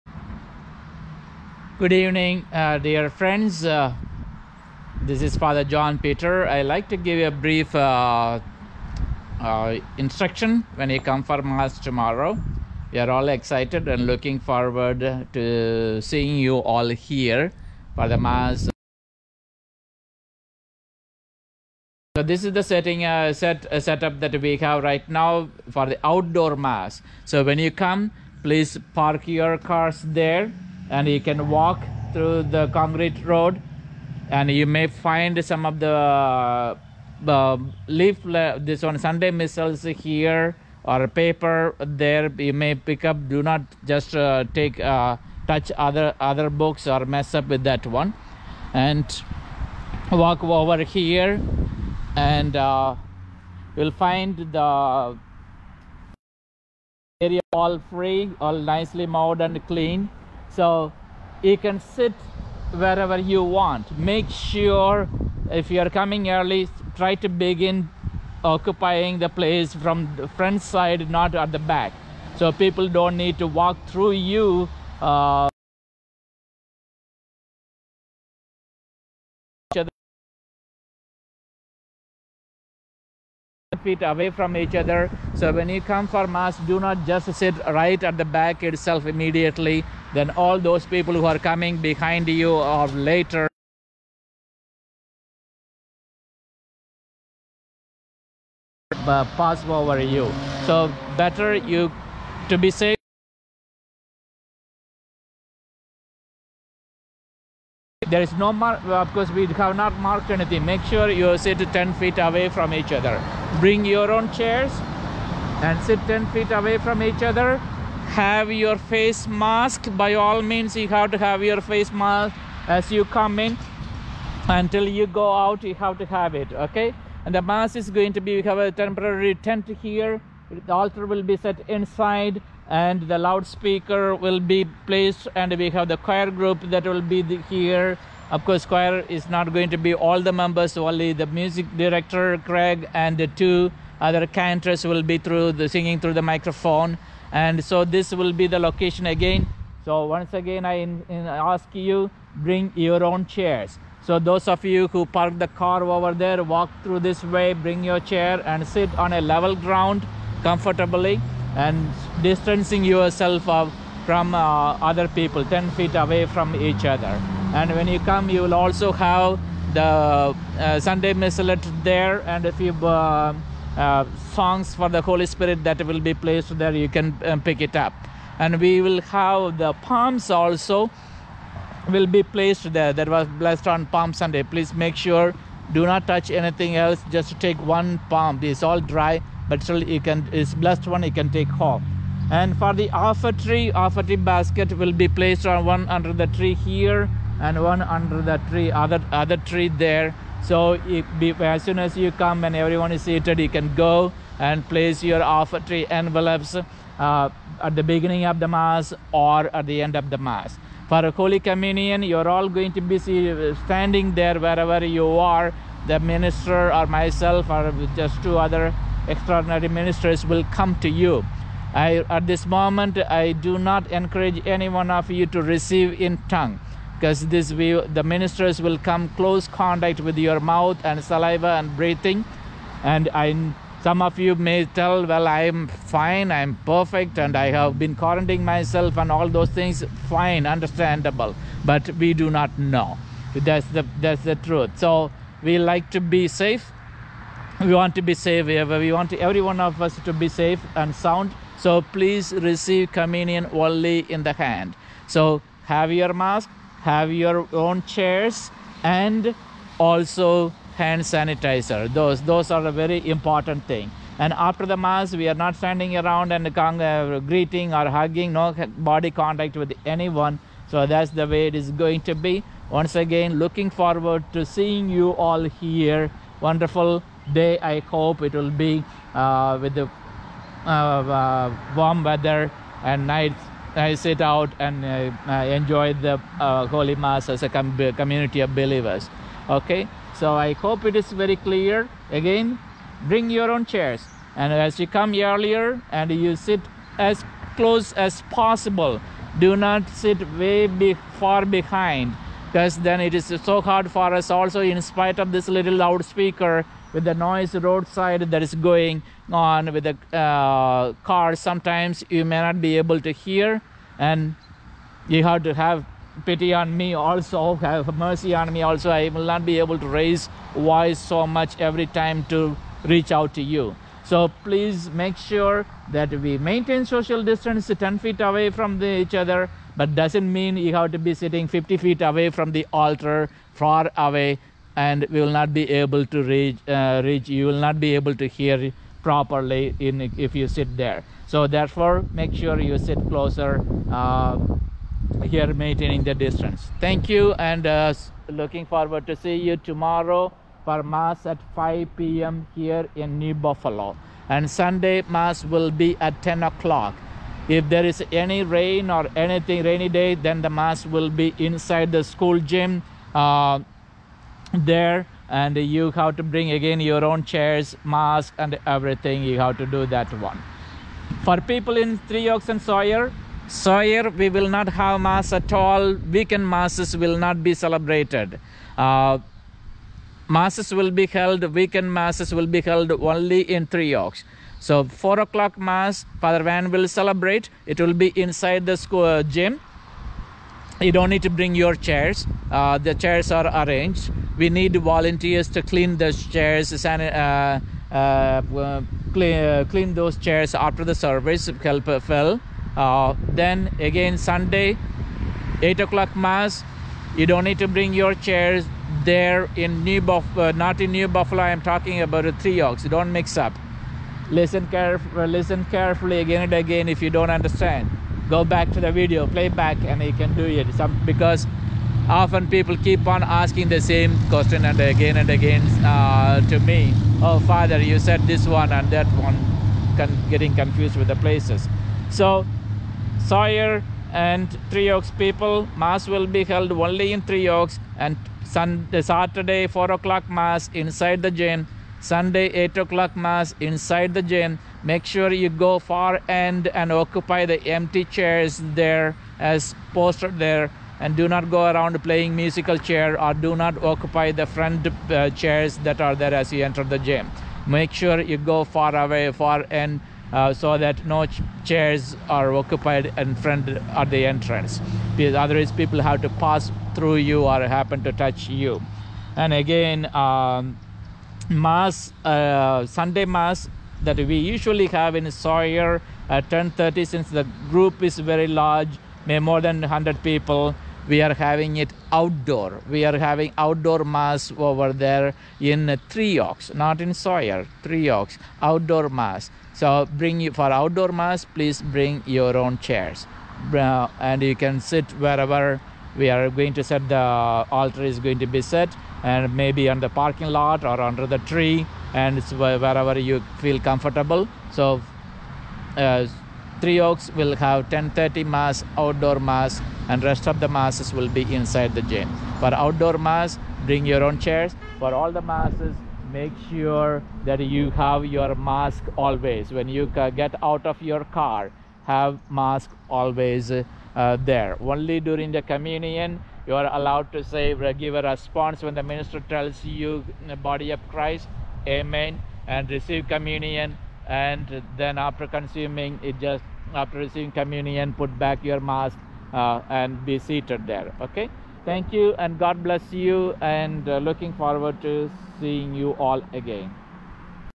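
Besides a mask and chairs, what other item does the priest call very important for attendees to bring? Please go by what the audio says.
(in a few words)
Hand sanitizer.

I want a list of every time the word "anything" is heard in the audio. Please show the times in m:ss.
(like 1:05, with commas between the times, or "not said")
1:50, 3:06, 5:59.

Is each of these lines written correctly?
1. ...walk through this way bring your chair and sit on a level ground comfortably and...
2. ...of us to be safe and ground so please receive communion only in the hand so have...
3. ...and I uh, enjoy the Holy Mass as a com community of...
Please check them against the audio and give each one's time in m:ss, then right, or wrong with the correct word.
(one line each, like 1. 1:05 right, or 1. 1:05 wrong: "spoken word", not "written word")
1. 2:36 right
2. 4:09 wrong: "sound", not "ground"
3. 4:44 right.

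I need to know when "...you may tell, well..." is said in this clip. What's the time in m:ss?
3:54.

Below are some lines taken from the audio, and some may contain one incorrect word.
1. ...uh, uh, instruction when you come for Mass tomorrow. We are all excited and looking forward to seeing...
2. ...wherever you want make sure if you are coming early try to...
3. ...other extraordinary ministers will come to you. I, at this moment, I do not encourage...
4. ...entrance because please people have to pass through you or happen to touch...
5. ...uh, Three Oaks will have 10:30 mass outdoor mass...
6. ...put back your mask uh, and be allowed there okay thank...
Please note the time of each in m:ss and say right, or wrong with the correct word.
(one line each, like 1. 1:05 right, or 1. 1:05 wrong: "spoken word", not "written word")
1. 0:07 right
2. 1:02 right
3. 3:38 right
4. 7:44 wrong: "otherwise", not "please"
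5. 8:25 right
6. 8:58 wrong: "seated", not "allowed".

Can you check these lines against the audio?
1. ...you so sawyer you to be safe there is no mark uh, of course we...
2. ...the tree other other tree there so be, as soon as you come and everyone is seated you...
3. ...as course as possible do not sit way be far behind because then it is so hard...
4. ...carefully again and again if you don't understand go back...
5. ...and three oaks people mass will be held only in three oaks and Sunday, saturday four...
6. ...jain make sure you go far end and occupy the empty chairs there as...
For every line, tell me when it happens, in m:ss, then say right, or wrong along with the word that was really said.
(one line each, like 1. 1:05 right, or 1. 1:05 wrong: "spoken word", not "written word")
1. 1:39 wrong: "better", not "sawyer"
2. 3:18 right
3. 4:56 wrong: "close", not "course"
4. 6:55 right
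5. 7:14 right
6. 7:24 right.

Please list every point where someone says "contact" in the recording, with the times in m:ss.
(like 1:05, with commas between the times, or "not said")
3:49, 4:29.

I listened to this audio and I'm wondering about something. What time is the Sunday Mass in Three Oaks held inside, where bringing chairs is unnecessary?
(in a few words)
8 o'clock.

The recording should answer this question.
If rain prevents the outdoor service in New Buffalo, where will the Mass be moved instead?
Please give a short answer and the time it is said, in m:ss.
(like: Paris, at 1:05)
School gym, at 6:01.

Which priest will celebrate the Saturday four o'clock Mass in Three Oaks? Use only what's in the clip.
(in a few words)
Father Van.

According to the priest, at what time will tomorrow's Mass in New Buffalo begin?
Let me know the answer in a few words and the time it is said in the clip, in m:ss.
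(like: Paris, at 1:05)
5 p.m., at 5:51.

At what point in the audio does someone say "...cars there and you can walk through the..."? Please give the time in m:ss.
0:29.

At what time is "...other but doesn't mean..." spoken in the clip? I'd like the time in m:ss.
5:29.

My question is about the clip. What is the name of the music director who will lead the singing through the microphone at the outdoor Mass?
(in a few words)
Craig.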